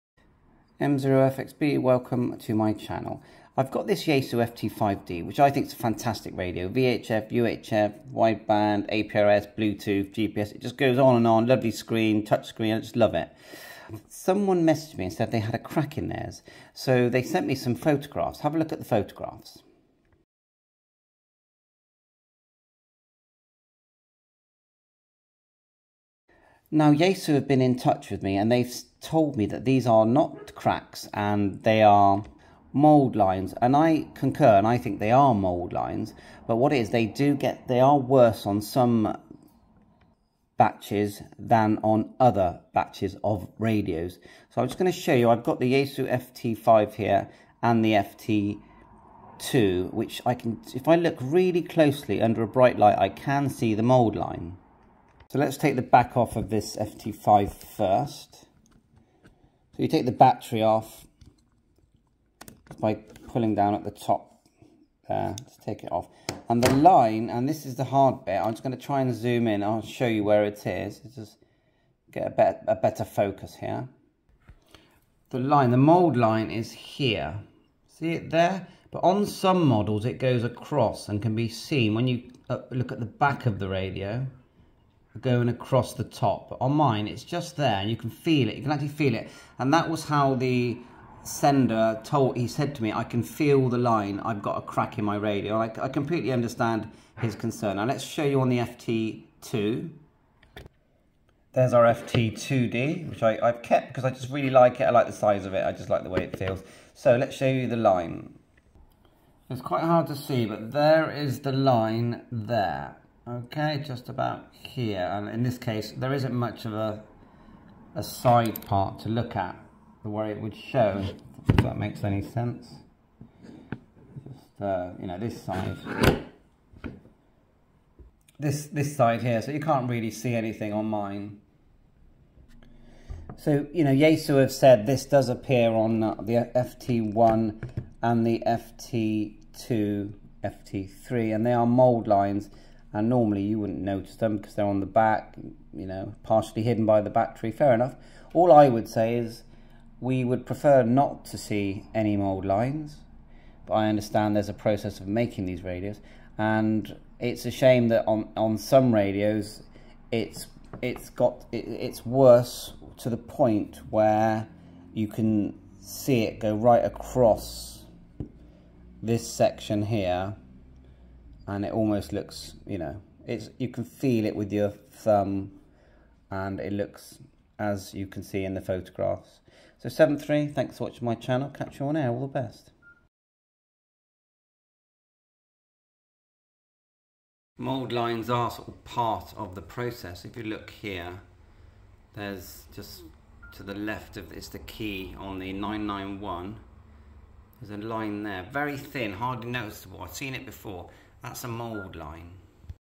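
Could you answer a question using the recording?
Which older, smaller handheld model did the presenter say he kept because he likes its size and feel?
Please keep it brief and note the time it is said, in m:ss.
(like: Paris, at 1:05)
FT2D, at 1:41.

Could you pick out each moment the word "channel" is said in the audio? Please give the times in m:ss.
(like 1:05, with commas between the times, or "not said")
0:02, 3:01.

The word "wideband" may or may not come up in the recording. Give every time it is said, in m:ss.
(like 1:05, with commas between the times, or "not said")
0:08.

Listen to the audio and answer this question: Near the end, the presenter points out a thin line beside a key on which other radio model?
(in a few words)
991.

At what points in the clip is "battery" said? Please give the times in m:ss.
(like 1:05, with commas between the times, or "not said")
1:00, 2:27.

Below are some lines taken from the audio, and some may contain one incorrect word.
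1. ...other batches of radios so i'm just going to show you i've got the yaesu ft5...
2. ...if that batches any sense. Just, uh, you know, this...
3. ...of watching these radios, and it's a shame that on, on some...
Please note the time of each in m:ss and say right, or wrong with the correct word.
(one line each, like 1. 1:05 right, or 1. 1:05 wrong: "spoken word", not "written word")
1. 0:42 right
2. 2:01 wrong: "makes", not "batches"
3. 2:34 wrong: "making", not "watching".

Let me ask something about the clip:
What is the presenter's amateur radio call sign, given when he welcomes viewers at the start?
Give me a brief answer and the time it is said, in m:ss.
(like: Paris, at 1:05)
M0FXB, at 0:00.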